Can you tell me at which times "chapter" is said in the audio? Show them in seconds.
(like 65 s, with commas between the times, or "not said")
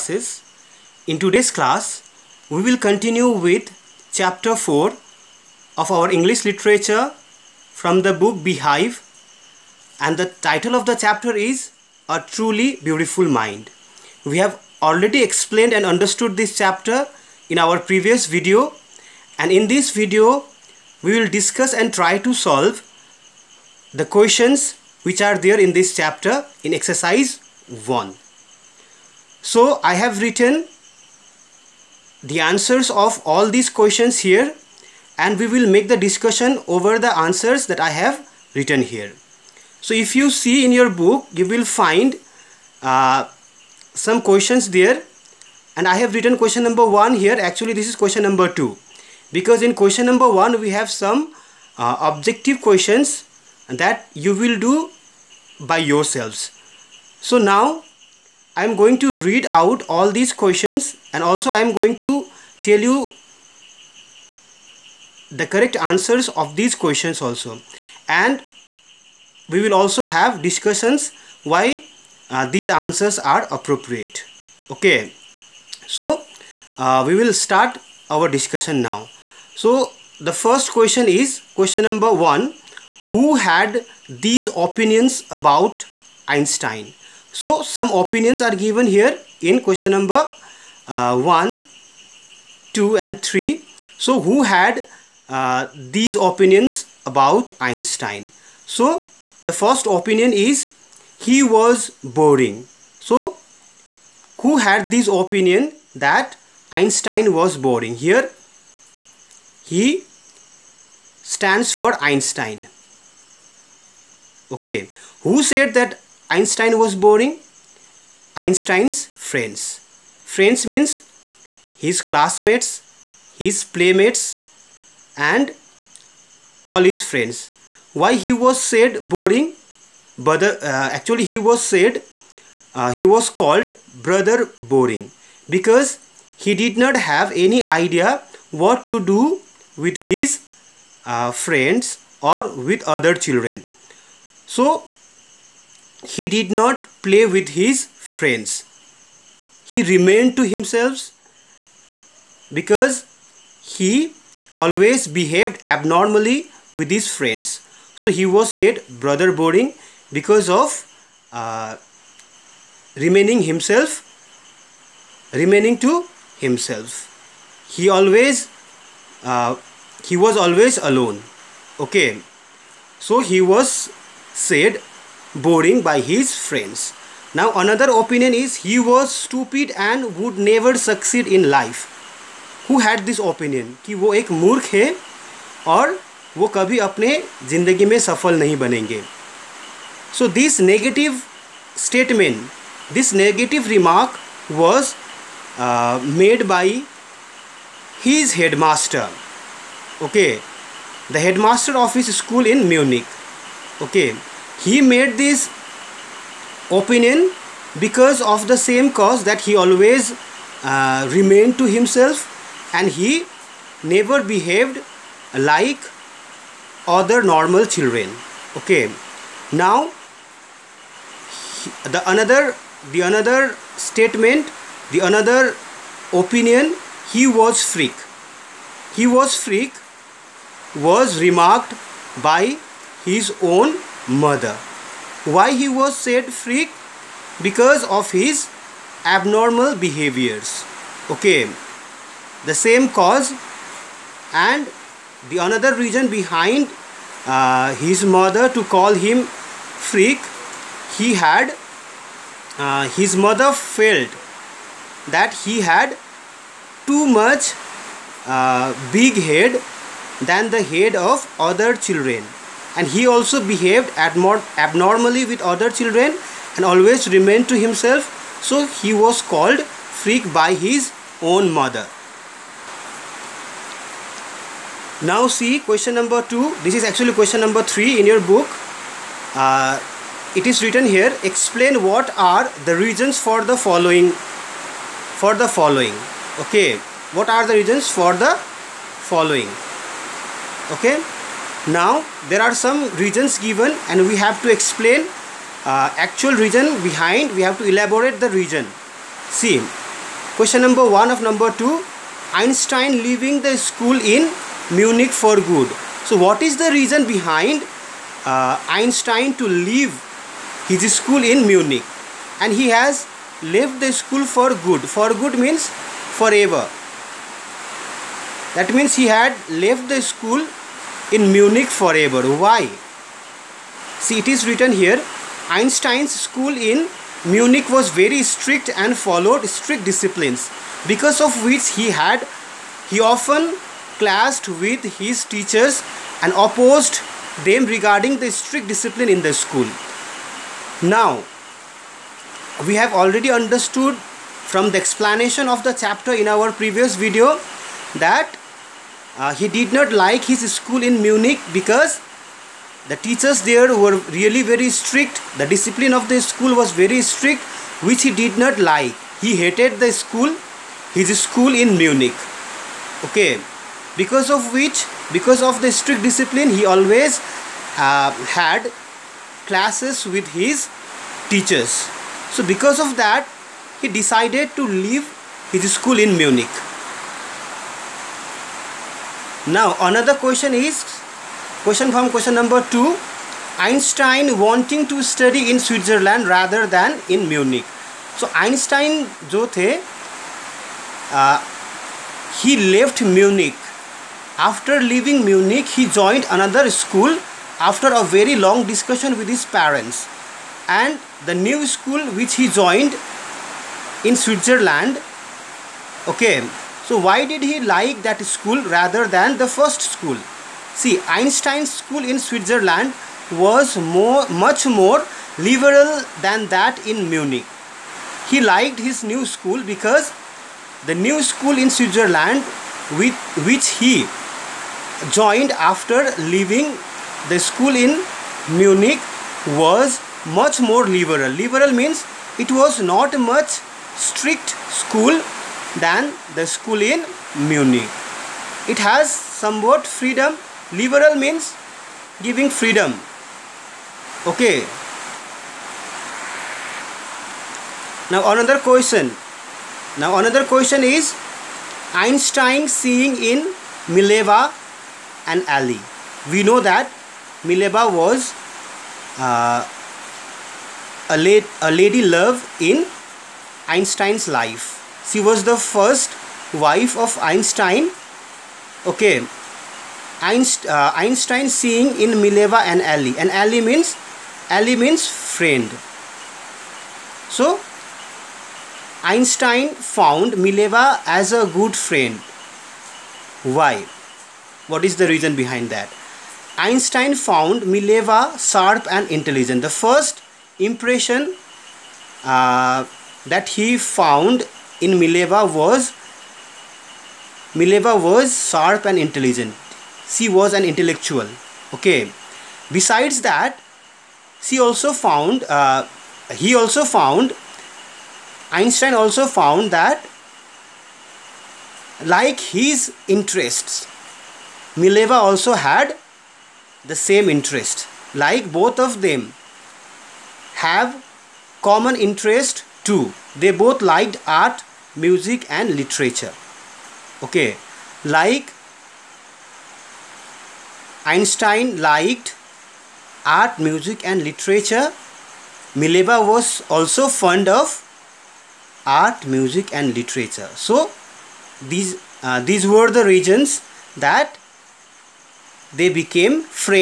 4 s, 10 s, 16 s, 25 s, 345 s.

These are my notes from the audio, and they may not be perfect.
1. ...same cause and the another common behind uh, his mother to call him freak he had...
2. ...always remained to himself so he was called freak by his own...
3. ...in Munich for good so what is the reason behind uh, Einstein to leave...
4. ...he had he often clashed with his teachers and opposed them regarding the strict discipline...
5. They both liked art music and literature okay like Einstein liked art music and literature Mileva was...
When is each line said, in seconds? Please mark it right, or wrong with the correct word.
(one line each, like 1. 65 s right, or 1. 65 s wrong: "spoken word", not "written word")
1. 242 s wrong: "reason", not "common"
2. 266 s right
3. 304 s right
4. 331 s right
5. 523 s right.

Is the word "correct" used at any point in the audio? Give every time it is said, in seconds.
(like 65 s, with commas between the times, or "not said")
65 s.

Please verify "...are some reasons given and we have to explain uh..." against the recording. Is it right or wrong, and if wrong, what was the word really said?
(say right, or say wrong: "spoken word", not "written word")
right.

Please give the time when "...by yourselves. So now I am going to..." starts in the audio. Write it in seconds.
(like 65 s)
55 s.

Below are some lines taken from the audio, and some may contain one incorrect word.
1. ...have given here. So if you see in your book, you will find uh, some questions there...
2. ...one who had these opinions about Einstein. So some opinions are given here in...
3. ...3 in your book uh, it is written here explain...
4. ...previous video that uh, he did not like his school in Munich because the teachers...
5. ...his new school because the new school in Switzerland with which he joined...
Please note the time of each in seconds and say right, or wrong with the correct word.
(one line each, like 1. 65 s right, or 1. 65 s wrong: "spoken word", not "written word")
1. 37 s wrong: "written", not "given"
2. 82 s right
3. 277 s right
4. 346 s right
5. 418 s right.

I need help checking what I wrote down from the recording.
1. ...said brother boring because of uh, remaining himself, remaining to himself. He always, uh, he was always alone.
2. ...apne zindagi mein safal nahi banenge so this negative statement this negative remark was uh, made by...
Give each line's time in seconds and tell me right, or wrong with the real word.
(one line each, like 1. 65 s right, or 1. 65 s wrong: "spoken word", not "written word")
1. 158 s right
2. 186 s right.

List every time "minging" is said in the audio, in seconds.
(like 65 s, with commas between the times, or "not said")
not said.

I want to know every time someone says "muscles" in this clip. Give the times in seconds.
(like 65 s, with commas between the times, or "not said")
not said.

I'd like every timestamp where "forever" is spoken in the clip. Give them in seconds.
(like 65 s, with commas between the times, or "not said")
315 s, 321 s.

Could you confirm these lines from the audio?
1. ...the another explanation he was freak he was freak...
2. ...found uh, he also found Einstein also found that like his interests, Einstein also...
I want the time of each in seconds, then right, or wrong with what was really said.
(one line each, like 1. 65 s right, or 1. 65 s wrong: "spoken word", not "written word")
1. 224 s wrong: "opinion", not "explanation"
2. 505 s wrong: "Mileva", not "Einstein".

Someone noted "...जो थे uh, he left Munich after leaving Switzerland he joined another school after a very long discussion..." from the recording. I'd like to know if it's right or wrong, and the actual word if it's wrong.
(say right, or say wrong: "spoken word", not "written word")
wrong: "Munich", not "Switzerland".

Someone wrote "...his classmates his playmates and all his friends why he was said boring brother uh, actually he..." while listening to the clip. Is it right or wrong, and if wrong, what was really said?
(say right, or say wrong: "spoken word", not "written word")
right.